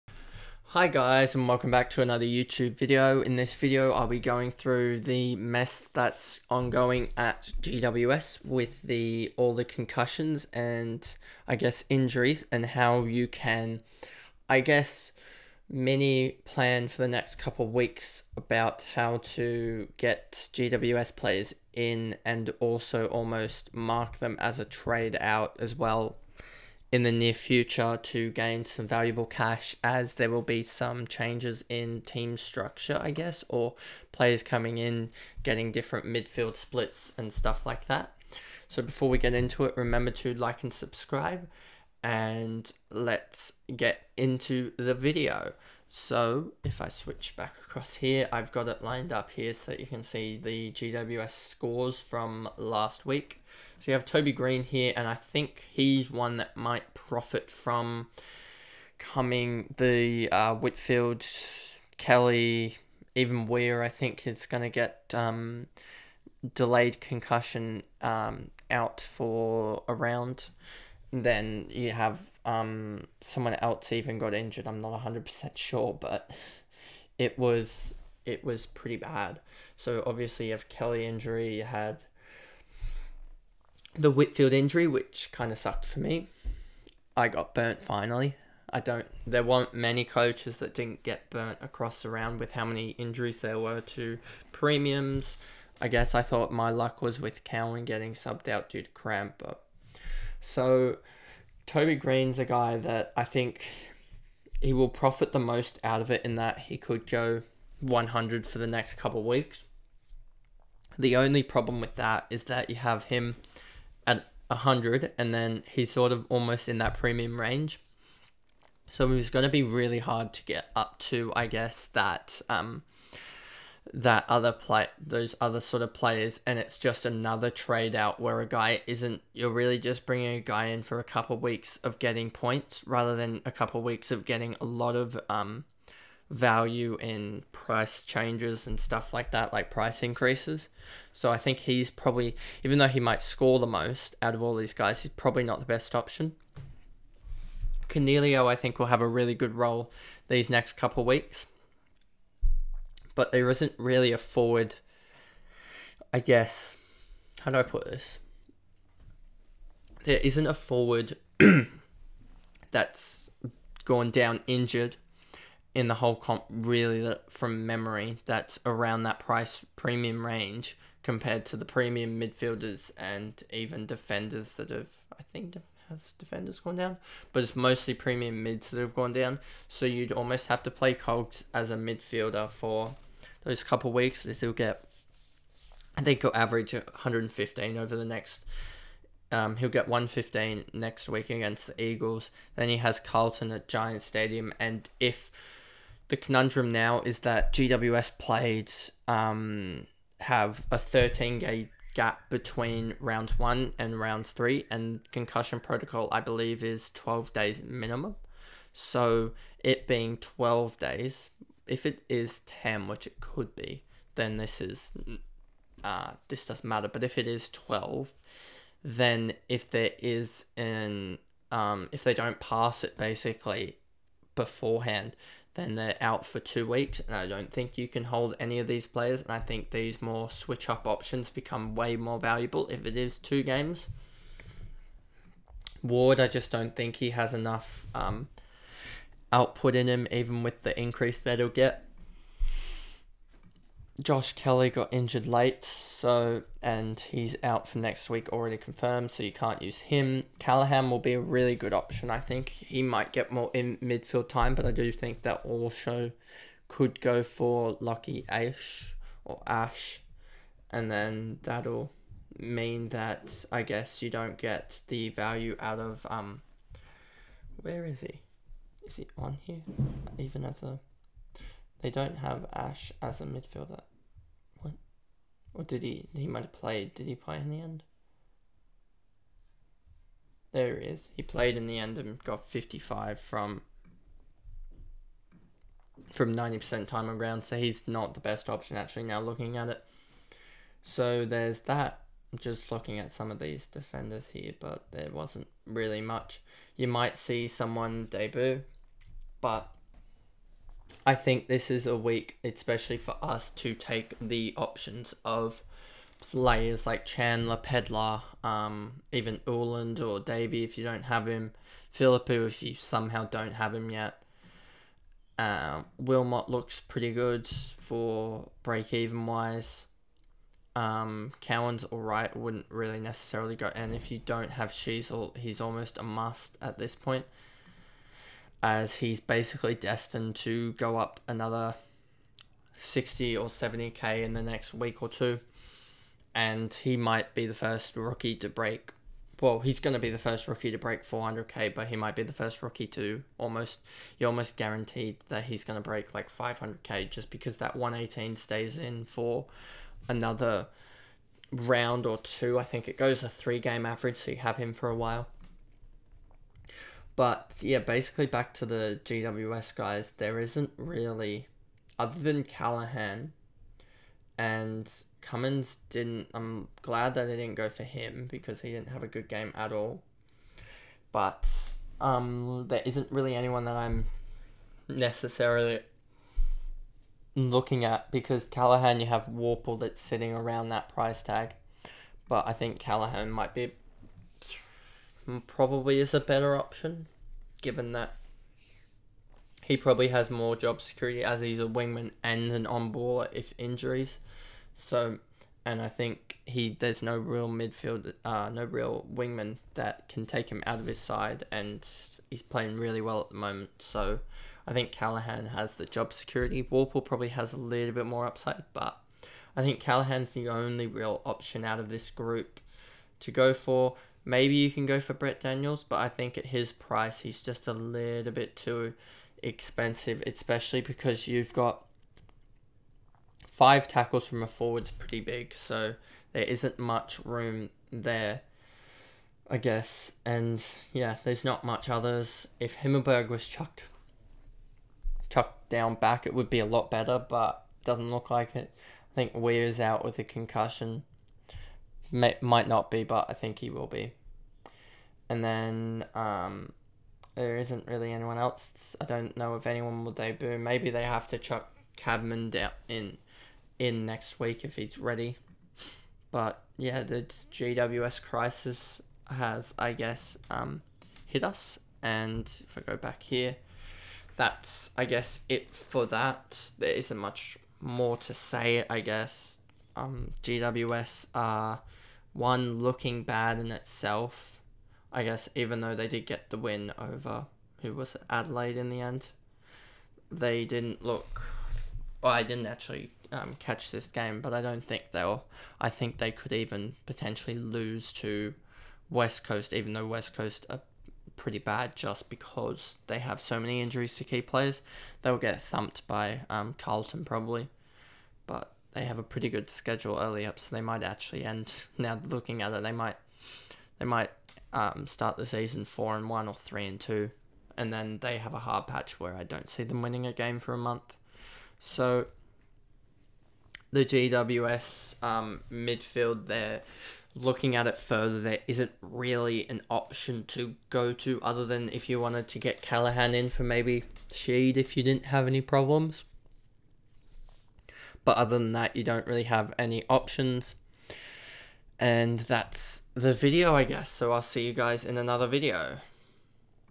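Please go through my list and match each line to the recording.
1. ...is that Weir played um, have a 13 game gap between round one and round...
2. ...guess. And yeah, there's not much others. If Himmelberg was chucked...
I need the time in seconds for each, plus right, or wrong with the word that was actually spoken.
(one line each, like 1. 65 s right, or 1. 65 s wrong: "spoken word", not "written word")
1. 197 s wrong: "GWS", not "Weir"
2. 429 s right.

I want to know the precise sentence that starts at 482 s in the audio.
Well, I didn't actually um, catch this game, but I don't think they'll.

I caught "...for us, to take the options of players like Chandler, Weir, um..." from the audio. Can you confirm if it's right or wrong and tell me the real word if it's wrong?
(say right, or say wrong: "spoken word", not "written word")
wrong: "Pedlar", not "Weir".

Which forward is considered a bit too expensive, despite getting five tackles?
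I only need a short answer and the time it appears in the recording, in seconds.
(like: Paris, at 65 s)
Brent Daniels, at 415 s.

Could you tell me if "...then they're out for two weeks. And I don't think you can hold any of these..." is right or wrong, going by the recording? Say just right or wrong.
right.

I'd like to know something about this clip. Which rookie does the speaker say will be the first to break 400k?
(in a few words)
Sheezel.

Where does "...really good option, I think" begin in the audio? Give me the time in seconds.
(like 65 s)
251 s.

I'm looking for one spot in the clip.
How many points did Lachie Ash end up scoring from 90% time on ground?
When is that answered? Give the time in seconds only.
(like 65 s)
282 s.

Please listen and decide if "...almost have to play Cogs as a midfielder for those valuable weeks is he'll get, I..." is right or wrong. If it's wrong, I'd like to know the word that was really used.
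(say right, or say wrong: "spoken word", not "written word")
wrong: "couple", not "valuable".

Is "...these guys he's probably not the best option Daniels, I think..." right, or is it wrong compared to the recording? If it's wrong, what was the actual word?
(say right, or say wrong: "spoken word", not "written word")
wrong: "Coniglio", not "Daniels".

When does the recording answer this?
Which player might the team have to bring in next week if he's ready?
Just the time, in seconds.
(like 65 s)
451 s.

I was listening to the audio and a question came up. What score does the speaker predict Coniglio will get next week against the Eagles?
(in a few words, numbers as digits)
115.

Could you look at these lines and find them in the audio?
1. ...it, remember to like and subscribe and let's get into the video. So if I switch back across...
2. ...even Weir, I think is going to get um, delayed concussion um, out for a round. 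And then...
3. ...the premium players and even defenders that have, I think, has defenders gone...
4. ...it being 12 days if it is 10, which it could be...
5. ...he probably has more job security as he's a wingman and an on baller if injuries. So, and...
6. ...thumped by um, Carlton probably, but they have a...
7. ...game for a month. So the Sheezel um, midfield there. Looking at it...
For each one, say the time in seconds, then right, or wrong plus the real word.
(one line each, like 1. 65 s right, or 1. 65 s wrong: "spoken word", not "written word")
1. 39 s right
2. 63 s right
3. 171 s wrong: "midfielders", not "players"
4. 209 s right
5. 389 s right
6. 495 s right
7. 510 s wrong: "GWS", not "Sheezel".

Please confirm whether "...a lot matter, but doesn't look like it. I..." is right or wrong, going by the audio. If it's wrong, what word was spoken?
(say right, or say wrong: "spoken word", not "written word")
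wrong: "better", not "matter".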